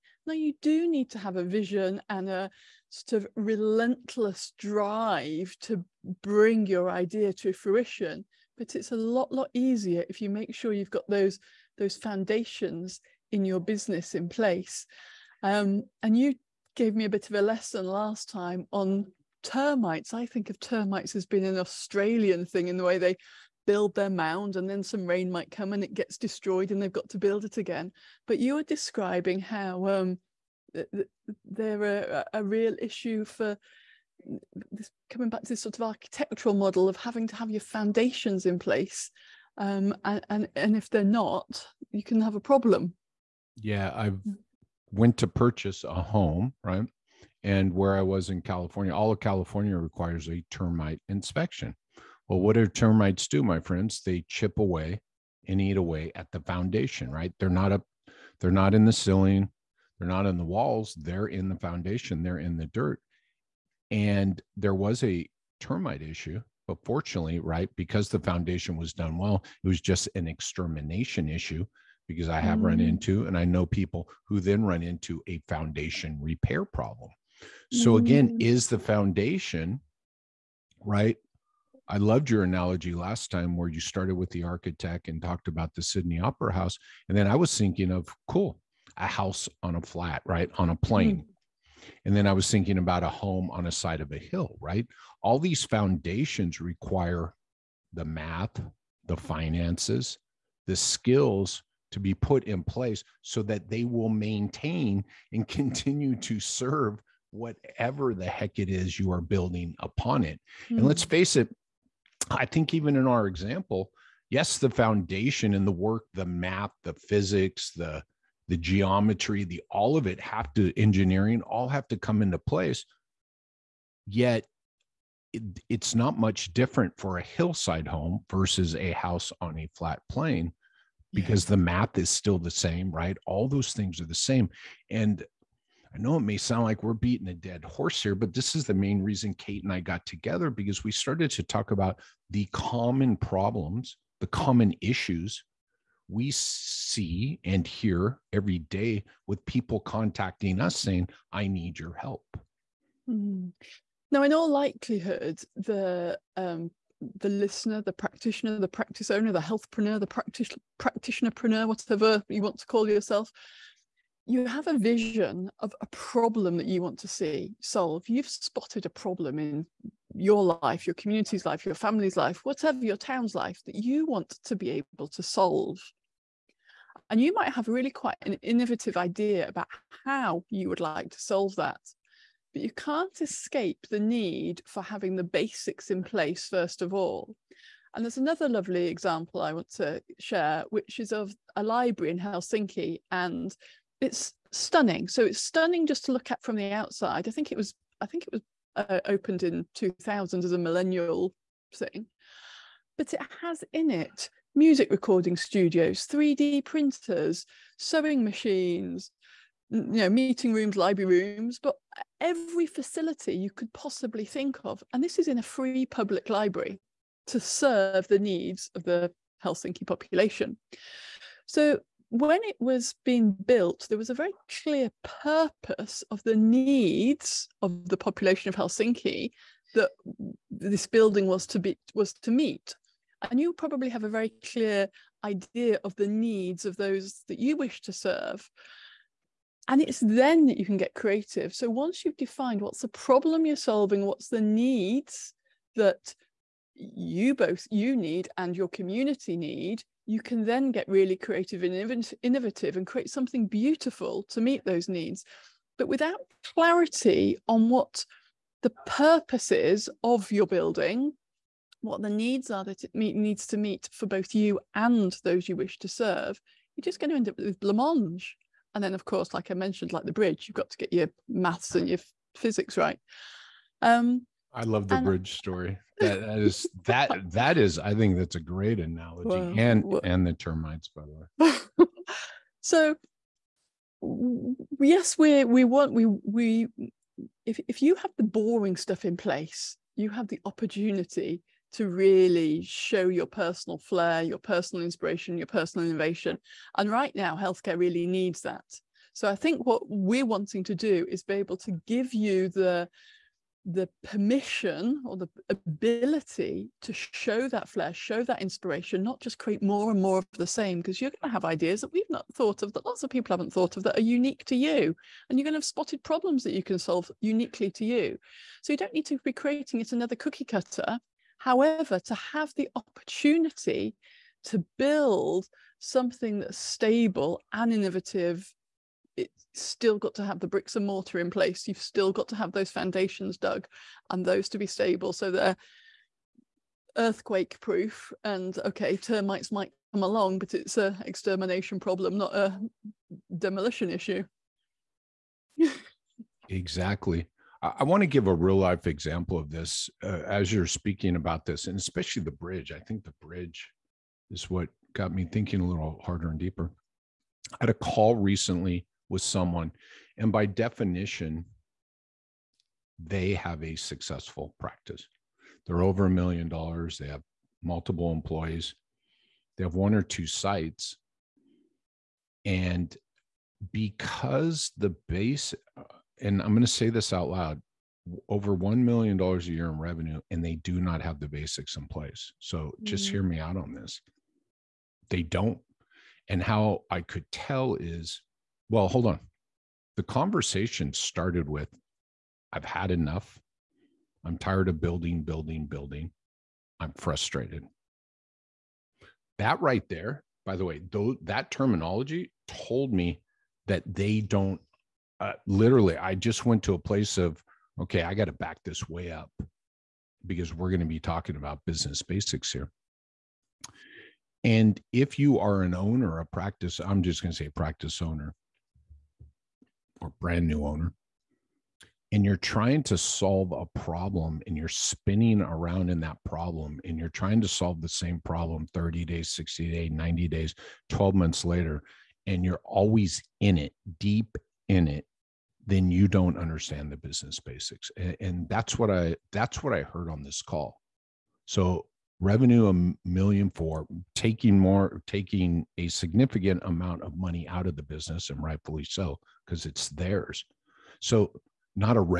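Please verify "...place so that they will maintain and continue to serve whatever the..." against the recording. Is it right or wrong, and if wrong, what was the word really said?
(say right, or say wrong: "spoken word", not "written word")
right.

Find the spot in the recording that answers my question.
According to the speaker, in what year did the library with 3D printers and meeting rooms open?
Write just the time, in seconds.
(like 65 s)
199 s.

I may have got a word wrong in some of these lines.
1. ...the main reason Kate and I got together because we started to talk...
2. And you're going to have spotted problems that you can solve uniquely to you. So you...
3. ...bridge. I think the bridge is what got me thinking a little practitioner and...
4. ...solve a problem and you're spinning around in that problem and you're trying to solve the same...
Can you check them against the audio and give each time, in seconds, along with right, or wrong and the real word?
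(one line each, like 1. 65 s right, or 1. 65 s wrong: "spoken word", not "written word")
1. 138 s right
2. 315 s right
3. 352 s wrong: "harder", not "practitioner"
4. 422 s right.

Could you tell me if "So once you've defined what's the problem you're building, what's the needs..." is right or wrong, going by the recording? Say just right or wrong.
wrong.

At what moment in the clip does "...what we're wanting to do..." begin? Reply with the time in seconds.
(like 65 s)
299 s.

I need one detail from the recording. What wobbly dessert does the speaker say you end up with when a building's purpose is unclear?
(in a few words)
blancmange.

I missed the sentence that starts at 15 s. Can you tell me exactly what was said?
Um, and you gave me a bit of a lesson last time on termites.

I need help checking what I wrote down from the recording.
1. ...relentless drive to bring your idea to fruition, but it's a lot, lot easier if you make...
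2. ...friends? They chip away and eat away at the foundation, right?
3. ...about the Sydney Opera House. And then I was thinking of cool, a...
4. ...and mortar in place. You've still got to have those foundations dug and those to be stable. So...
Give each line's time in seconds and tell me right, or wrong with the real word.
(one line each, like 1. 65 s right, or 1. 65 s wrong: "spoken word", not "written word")
1. 3 s right
2. 53 s right
3. 85 s right
4. 330 s right.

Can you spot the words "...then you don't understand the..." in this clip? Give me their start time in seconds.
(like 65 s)
435 s.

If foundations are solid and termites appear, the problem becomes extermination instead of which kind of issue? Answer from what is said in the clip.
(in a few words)
demolition issue.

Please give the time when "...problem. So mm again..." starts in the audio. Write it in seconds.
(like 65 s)
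76 s.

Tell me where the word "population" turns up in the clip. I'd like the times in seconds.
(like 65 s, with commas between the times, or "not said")
219 s, 227 s.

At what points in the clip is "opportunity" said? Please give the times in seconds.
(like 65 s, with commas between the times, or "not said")
290 s, 322 s.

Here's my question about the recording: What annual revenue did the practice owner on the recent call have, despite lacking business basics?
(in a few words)
over $1 million.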